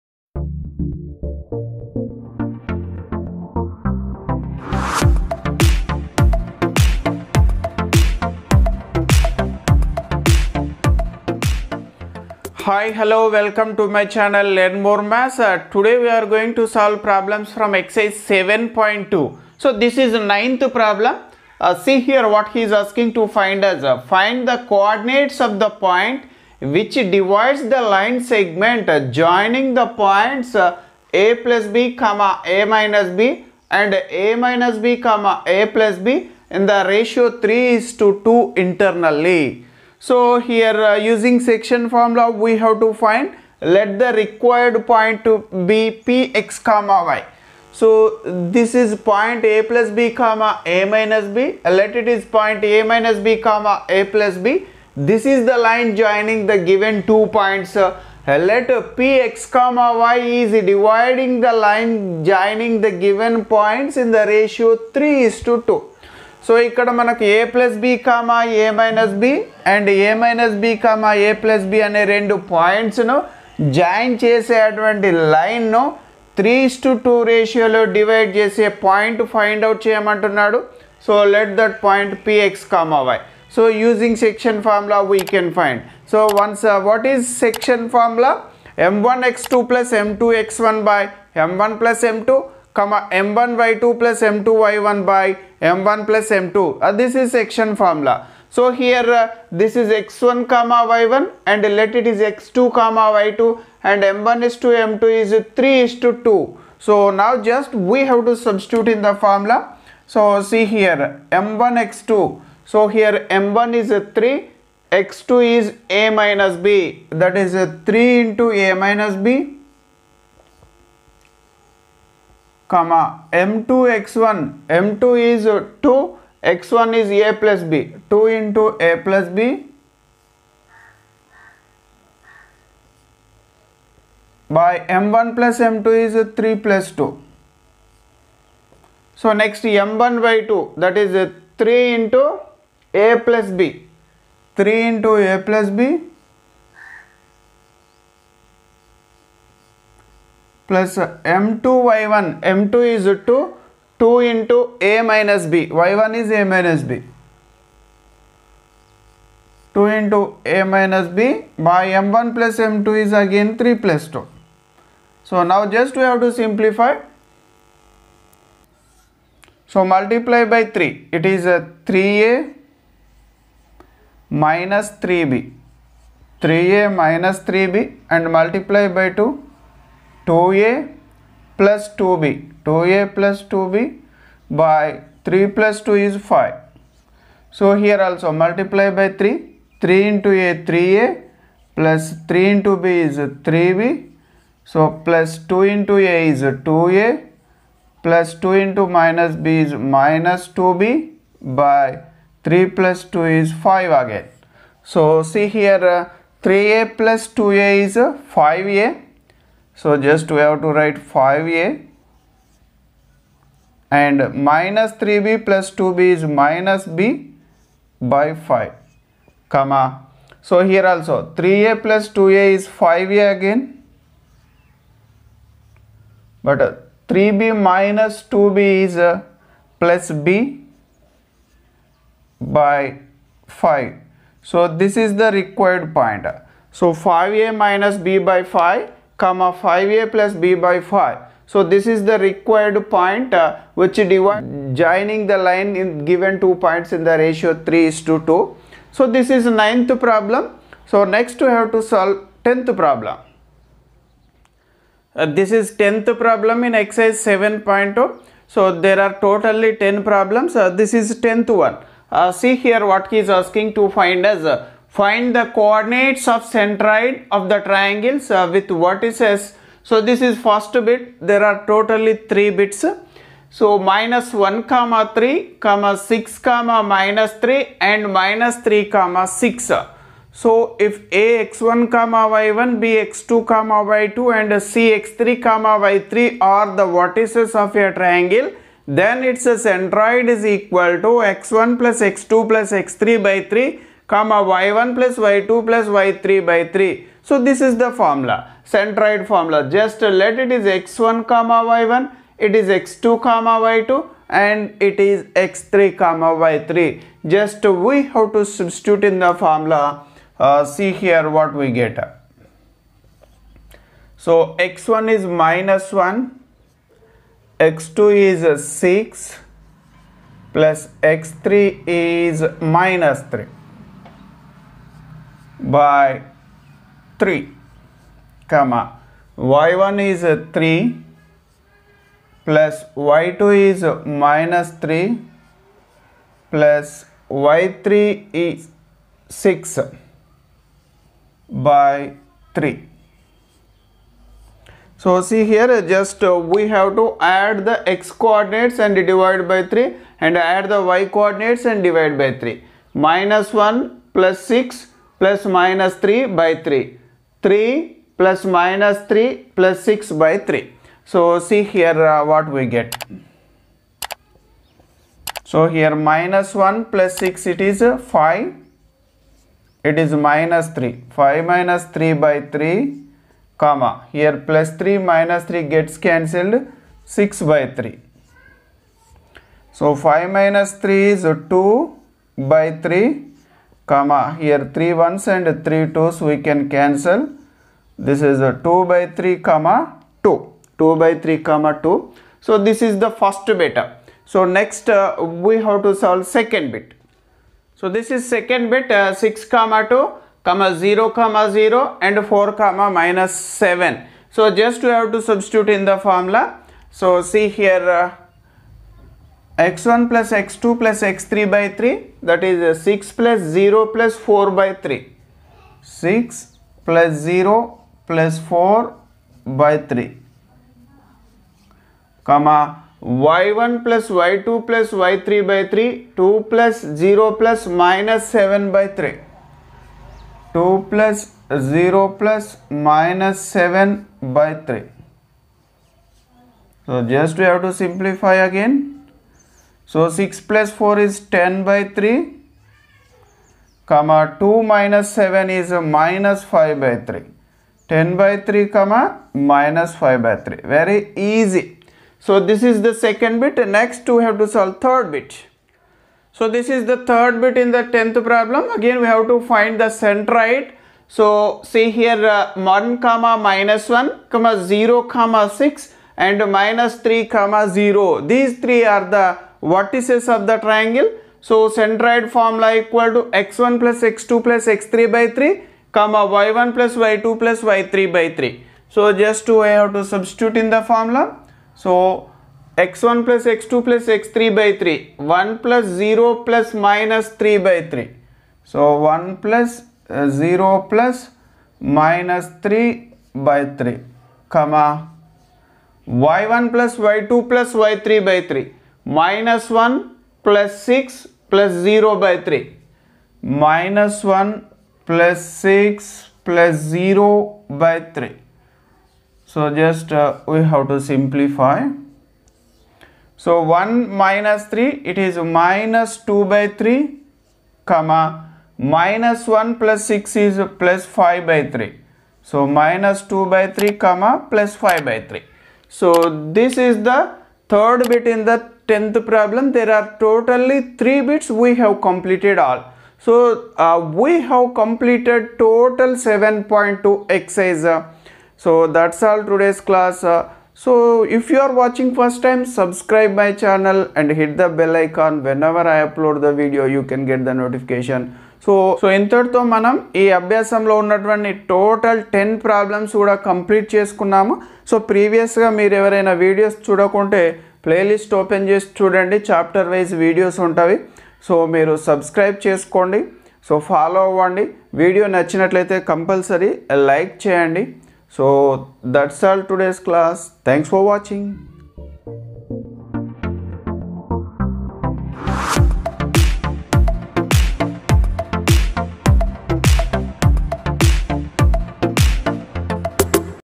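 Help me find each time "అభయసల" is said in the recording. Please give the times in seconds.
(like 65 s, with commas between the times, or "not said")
550 s.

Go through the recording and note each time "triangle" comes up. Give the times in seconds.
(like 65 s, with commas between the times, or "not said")
267 s, 287 s, 470 s.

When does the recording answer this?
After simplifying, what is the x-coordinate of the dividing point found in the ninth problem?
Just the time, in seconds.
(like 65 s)
236 s.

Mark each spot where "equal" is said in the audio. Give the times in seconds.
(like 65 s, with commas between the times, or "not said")
290 s, 472 s.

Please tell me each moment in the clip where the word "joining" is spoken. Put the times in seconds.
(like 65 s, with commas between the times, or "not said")
29 s, 55 s, 62 s, 244 s.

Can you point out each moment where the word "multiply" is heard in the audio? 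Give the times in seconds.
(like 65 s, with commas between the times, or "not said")
169 s, 178 s, 188 s.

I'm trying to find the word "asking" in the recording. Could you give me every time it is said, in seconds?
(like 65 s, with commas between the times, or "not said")
22 s, 263 s.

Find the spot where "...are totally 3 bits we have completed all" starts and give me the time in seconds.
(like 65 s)
529 s.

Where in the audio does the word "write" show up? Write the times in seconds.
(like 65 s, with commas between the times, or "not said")
210 s.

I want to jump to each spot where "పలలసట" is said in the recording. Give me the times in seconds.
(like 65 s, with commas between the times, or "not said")
557 s.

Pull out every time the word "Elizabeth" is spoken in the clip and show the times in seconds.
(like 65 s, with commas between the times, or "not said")
not said.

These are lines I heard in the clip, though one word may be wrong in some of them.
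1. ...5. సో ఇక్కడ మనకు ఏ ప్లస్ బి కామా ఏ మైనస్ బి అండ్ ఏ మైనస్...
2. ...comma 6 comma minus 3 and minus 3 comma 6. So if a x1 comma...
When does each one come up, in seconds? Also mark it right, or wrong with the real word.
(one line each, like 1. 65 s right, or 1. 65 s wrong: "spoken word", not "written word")
1. 65 s wrong: "2", not "5"
2. 275 s right.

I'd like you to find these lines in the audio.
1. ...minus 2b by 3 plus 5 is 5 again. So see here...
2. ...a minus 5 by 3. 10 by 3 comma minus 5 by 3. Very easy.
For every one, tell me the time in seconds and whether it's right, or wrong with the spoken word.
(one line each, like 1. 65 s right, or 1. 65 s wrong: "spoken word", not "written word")
1. 199 s wrong: "2", not "5"
2. 445 s right.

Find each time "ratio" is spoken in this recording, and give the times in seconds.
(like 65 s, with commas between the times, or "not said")
36 s, 64 s, 247 s.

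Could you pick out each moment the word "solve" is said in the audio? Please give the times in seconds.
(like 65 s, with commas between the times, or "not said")
16 s, 251 s, 396 s, 454 s.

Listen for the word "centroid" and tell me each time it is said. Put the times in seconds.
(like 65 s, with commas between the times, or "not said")
266 s, 289 s, 298 s, 460 s, 471 s.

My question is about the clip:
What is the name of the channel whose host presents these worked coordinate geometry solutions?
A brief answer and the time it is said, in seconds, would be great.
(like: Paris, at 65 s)
Learn More Maths, at 14 s.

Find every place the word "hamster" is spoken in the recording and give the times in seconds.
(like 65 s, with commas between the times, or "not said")
not said.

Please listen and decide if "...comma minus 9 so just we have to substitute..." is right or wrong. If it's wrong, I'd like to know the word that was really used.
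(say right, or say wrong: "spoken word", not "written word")
wrong: "7", not "9".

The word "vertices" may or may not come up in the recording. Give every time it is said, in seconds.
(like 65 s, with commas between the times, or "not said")
268 s, 286 s, 469 s.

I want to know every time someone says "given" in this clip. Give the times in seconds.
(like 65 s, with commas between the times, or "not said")
56 s, 63 s, 246 s.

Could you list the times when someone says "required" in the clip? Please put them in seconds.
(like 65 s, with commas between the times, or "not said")
44 s, 235 s, 242 s.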